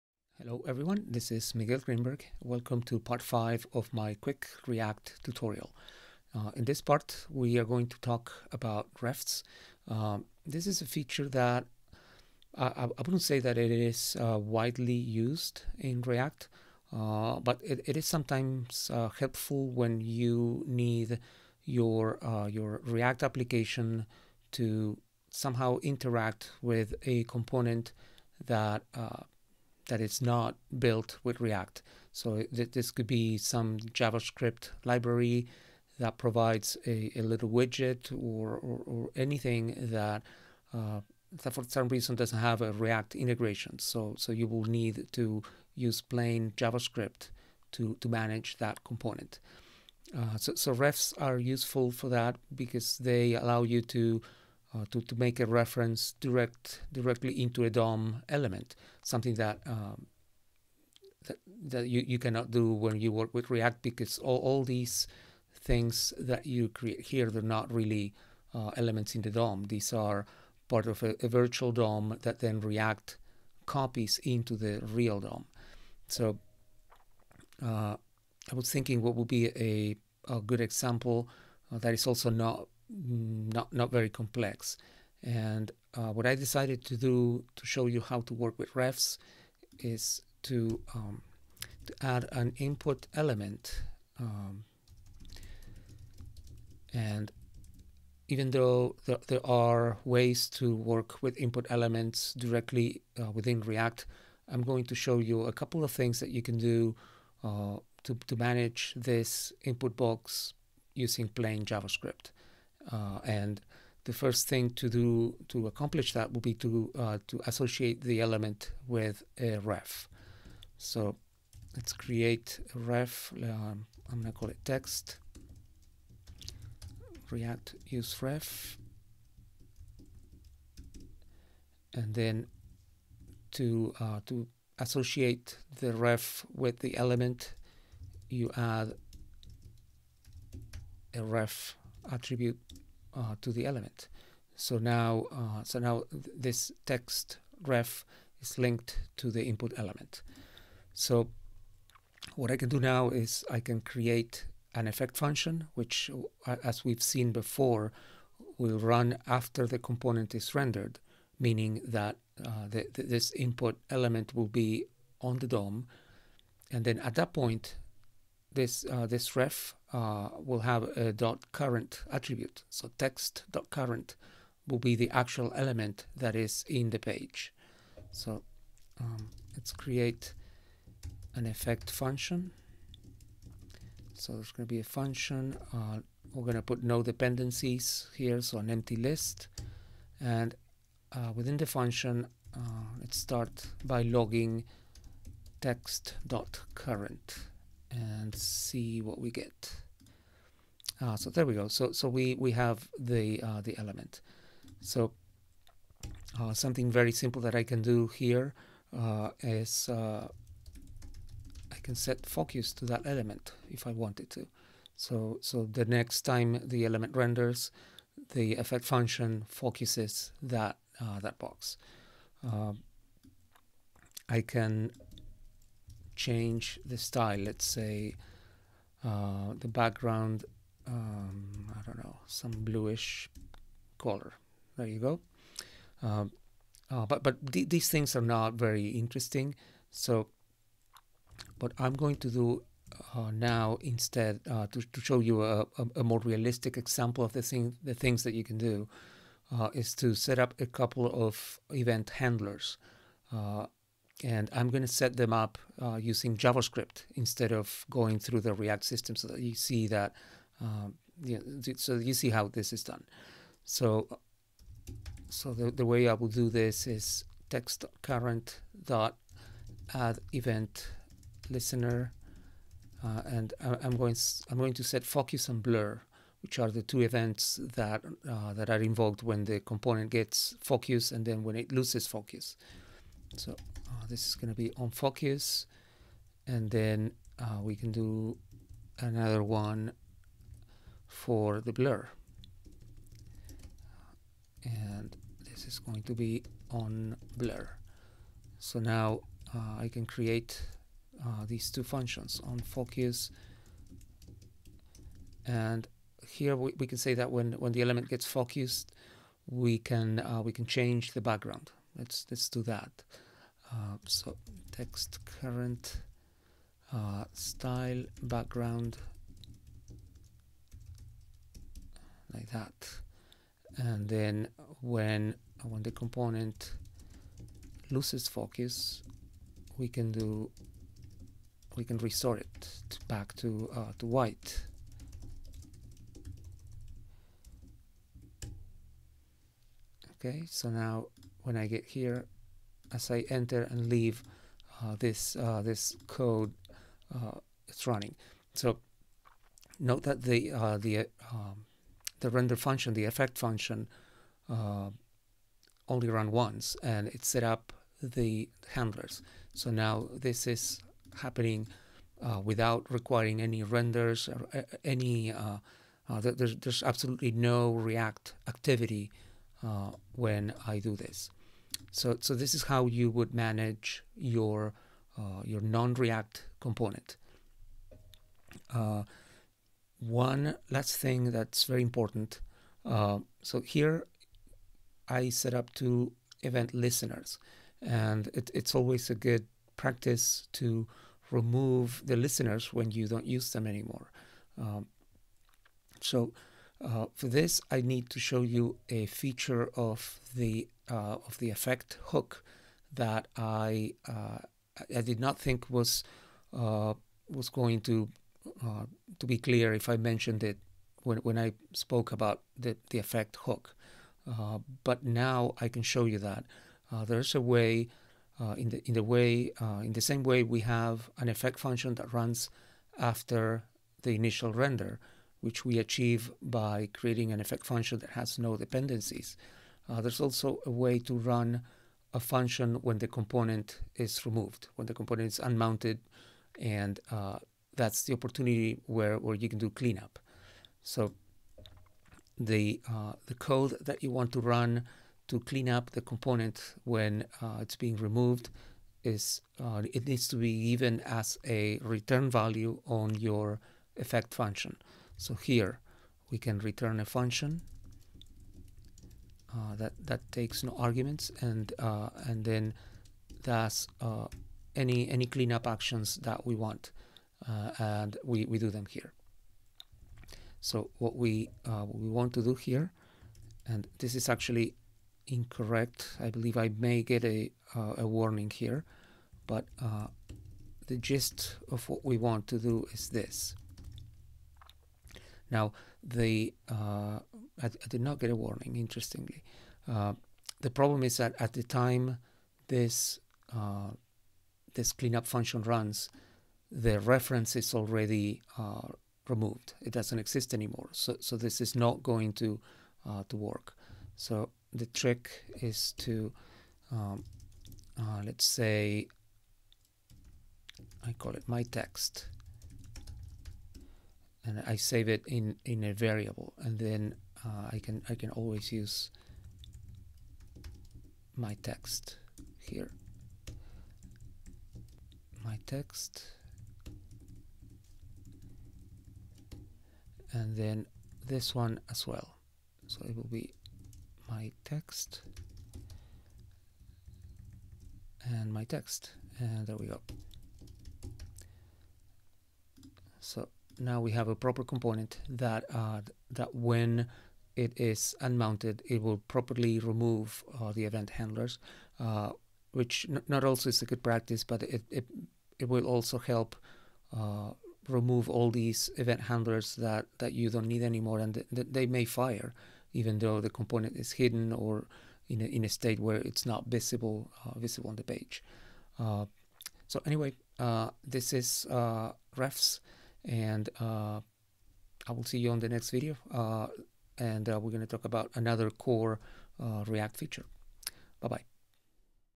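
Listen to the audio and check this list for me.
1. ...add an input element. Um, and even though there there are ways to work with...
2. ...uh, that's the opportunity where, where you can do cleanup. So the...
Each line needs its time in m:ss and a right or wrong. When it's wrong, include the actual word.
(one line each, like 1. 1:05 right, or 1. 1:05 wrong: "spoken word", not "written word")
1. 1:32 right
2. 7:17 right.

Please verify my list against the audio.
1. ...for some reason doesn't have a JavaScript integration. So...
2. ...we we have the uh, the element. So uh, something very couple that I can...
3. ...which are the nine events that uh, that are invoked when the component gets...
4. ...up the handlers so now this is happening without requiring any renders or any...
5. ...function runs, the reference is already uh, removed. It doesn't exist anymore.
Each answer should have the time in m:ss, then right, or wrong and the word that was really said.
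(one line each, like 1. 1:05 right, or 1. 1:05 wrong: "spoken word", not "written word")
1. 0:41 wrong: "React", not "JavaScript"
2. 3:22 wrong: "simple", not "couple"
3. 4:36 wrong: "two", not "nine"
4. 5:57 right
5. 8:15 right.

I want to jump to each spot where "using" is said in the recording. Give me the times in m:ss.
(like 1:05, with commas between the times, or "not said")
1:50, 4:15.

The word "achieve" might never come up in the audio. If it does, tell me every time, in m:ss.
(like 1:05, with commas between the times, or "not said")
7:05.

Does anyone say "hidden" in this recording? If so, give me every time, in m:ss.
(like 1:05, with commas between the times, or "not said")
9:24.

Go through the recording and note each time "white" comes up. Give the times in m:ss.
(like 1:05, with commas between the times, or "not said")
5:34.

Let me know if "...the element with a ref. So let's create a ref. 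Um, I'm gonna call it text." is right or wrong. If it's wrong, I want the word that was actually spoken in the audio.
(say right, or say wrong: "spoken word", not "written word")
right.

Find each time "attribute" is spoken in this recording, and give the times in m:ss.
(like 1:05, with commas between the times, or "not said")
2:22, 2:52.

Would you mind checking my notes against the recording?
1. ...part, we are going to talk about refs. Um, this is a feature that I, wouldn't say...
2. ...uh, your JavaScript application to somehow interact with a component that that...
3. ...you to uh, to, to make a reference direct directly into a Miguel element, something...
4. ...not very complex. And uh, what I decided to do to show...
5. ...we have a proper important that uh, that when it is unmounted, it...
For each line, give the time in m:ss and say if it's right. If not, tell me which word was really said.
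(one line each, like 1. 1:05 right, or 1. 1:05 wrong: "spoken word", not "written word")
1. 0:06 right
2. 0:22 wrong: "React", not "JavaScript"
3. 0:53 wrong: "DOM", not "Miguel"
4. 1:23 right
5. 9:04 wrong: "component", not "important".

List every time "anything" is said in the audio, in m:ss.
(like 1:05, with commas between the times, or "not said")
0:39.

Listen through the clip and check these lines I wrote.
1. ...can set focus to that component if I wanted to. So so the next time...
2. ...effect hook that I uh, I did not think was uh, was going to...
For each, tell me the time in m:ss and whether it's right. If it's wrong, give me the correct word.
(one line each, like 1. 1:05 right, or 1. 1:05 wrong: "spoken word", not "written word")
1. 3:31 wrong: "element", not "component"
2. 6:41 right.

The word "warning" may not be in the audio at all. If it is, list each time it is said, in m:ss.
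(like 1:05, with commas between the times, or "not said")
7:58, 8:08.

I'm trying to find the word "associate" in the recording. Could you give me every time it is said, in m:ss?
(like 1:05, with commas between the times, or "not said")
1:57, 2:14.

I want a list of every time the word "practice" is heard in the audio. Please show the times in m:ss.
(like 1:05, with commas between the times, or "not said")
6:29, 9:14.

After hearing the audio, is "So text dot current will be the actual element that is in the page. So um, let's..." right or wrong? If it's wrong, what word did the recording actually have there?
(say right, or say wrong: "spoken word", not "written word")
right.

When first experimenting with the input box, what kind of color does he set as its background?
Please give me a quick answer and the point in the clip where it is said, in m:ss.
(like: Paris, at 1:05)
bluish, at 3:52.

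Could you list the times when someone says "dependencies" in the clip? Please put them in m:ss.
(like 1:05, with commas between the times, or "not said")
3:07, 7:08.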